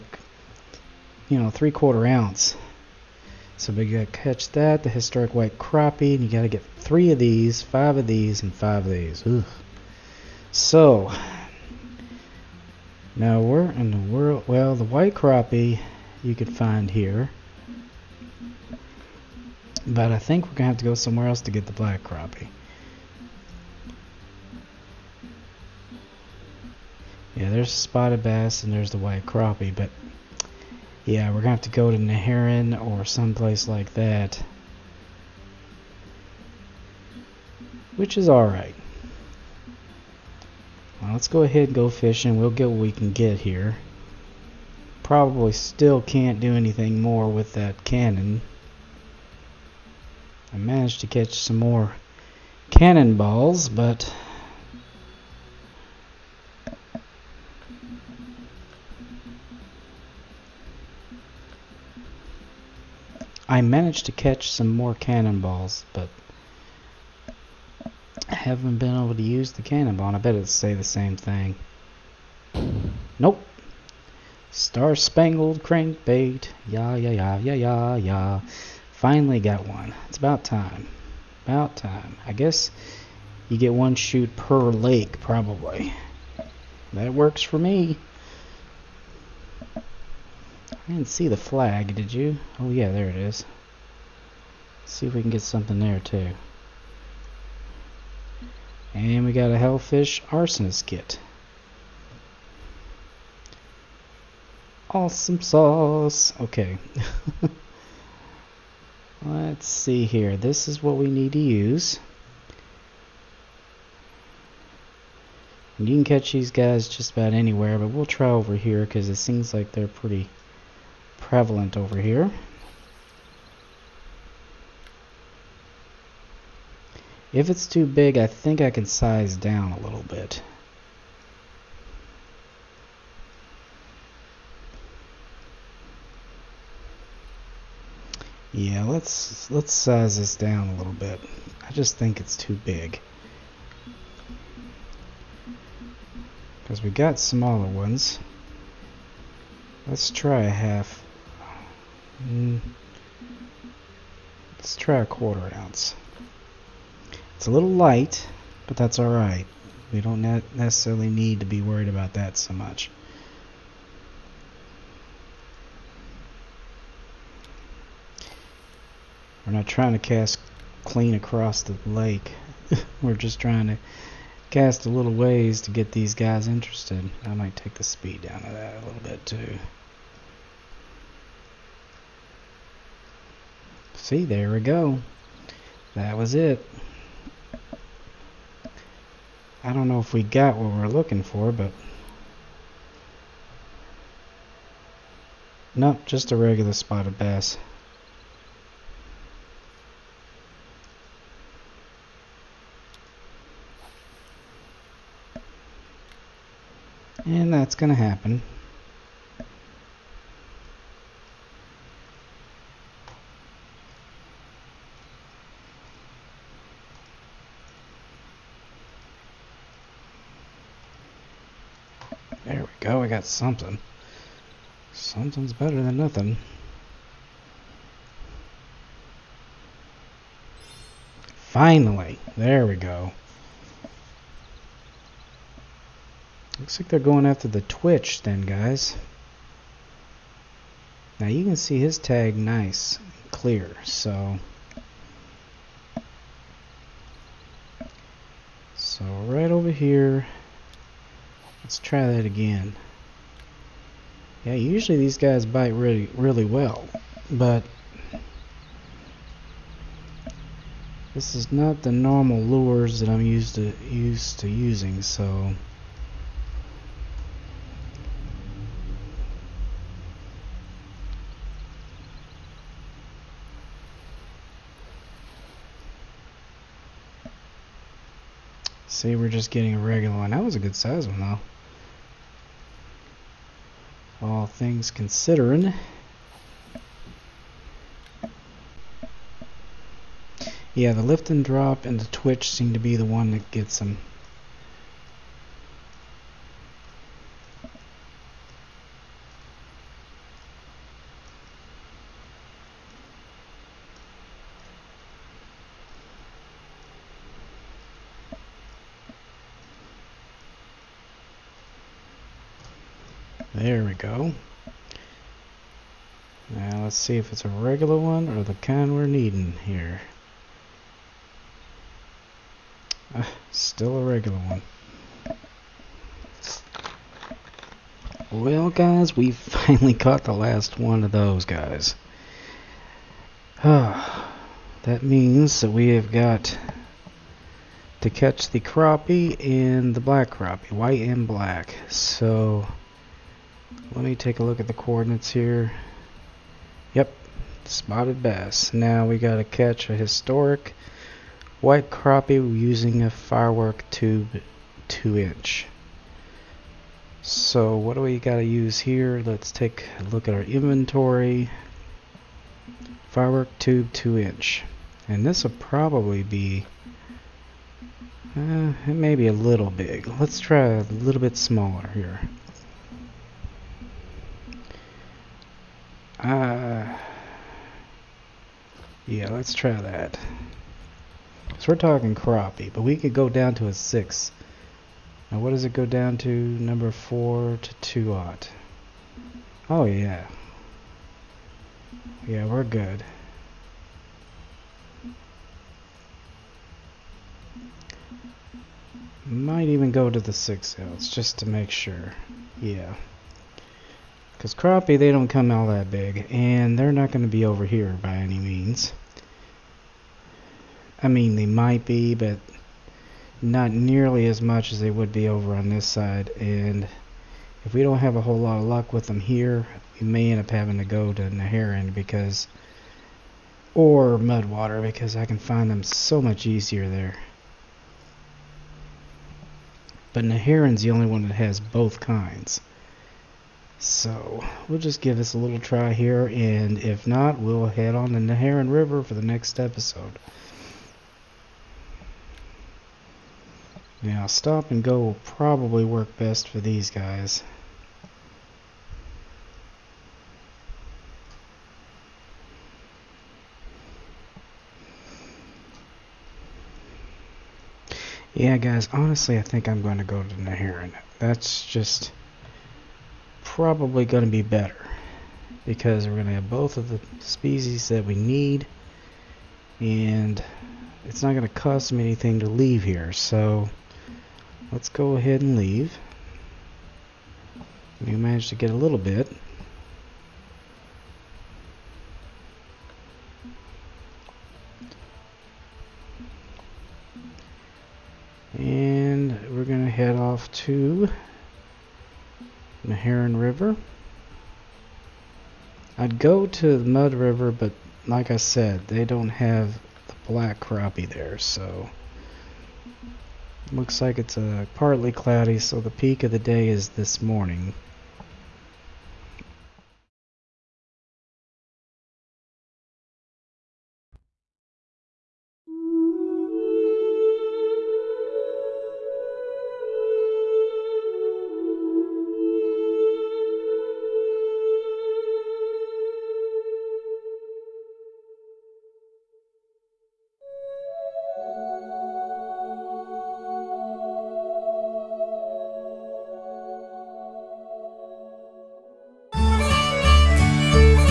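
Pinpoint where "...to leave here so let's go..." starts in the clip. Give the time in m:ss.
7:52.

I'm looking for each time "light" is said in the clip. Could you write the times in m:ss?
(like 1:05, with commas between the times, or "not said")
2:37.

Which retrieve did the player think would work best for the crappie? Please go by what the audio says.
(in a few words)
stop and go.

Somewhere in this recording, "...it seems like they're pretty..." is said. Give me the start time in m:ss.
1:59.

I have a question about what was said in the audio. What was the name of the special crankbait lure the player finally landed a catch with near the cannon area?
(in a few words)
Star Spangled Crankbait.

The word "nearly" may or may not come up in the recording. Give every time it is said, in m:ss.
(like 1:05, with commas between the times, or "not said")
6:53.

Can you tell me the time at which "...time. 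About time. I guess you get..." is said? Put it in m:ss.
1:20.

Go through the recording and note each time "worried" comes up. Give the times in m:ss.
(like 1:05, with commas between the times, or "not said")
2:41.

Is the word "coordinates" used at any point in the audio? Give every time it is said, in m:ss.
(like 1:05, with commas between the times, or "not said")
5:44.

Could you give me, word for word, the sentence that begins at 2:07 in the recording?
If it's too big, I think I can size down a little bit.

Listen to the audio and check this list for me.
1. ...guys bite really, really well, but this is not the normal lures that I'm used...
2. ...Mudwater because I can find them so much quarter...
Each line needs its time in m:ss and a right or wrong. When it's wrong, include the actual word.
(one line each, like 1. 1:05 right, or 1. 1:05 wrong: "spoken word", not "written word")
1. 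4:15 right
2. 7:04 wrong: "easier", not "quarter".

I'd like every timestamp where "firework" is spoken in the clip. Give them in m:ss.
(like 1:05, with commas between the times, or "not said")
5:53, 6:03.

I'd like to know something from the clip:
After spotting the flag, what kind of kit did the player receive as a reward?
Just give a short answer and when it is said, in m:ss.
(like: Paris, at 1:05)
Hellfish Arsonist kit, at 1:39.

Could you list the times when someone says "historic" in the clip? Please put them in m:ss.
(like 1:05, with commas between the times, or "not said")
0:04, 5:49.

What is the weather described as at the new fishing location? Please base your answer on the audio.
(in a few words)
partly cloudy.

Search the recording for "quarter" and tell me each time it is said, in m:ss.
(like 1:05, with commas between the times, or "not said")
0:01, 2:35.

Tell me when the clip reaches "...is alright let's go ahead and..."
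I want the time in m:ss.
0:38.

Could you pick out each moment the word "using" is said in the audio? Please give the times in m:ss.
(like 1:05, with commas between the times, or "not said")
4:24, 5:52.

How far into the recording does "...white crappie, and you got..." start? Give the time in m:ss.
0:05.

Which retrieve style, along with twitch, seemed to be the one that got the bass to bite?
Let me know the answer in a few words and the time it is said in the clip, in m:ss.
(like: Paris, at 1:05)
lift and drop, at 4:51.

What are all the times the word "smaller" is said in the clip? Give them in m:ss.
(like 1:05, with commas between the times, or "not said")
2:27, 6:11.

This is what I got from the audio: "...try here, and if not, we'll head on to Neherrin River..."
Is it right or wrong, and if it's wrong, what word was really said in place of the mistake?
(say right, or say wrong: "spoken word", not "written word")
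right.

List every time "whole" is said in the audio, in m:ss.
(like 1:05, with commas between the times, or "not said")
6:58.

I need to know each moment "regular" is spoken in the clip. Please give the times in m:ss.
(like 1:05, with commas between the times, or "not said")
3:16, 4:39, 5:17, 5:24.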